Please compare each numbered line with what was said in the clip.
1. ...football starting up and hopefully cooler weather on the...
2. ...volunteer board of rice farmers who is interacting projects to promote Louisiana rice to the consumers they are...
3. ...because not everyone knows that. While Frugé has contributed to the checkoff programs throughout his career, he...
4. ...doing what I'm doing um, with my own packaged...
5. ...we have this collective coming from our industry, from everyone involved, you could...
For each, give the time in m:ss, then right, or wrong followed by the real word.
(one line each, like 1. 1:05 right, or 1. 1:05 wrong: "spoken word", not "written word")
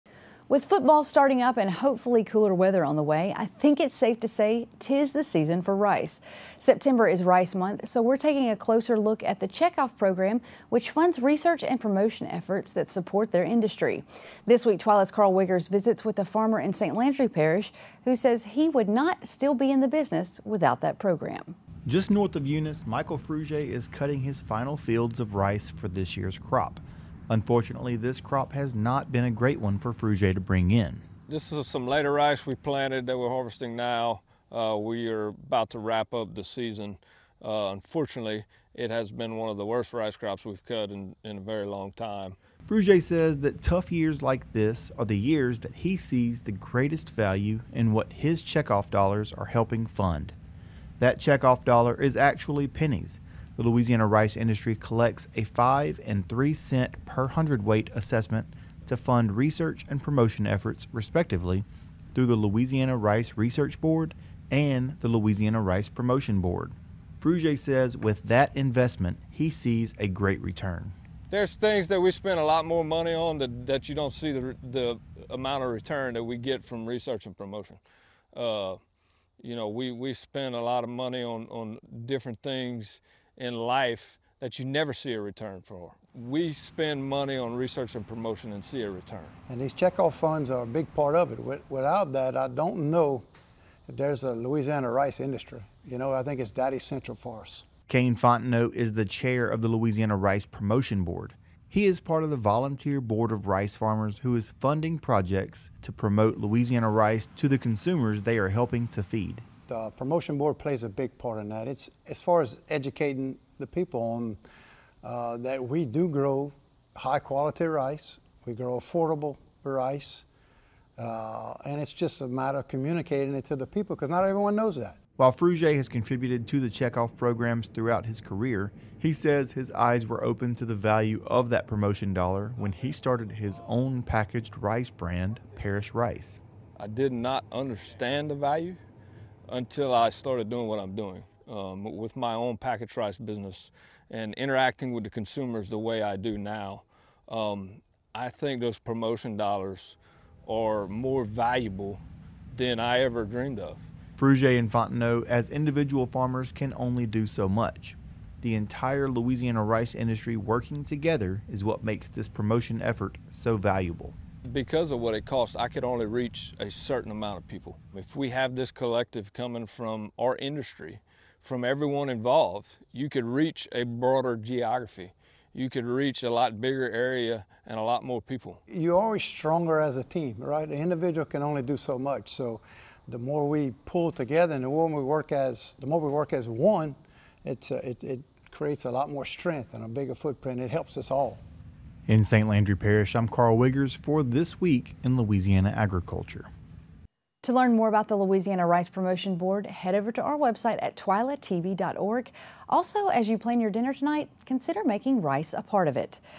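1. 0:00 right
2. 1:42 wrong: "funding", not "interacting"
3. 2:03 right
4. 2:20 right
5. 2:48 right.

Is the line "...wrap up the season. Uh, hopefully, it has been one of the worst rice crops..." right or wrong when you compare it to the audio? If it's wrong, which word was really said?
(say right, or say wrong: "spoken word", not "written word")
wrong: "unfortunately", not "hopefully".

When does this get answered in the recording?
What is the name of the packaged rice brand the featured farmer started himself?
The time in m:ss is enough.
2:15.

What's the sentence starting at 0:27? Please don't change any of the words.
Unfortunately, this crop has not been a great one for Frugé to bring in.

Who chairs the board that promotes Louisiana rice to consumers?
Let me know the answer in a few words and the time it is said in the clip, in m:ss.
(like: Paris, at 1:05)
Kane Fontenot, at 1:37.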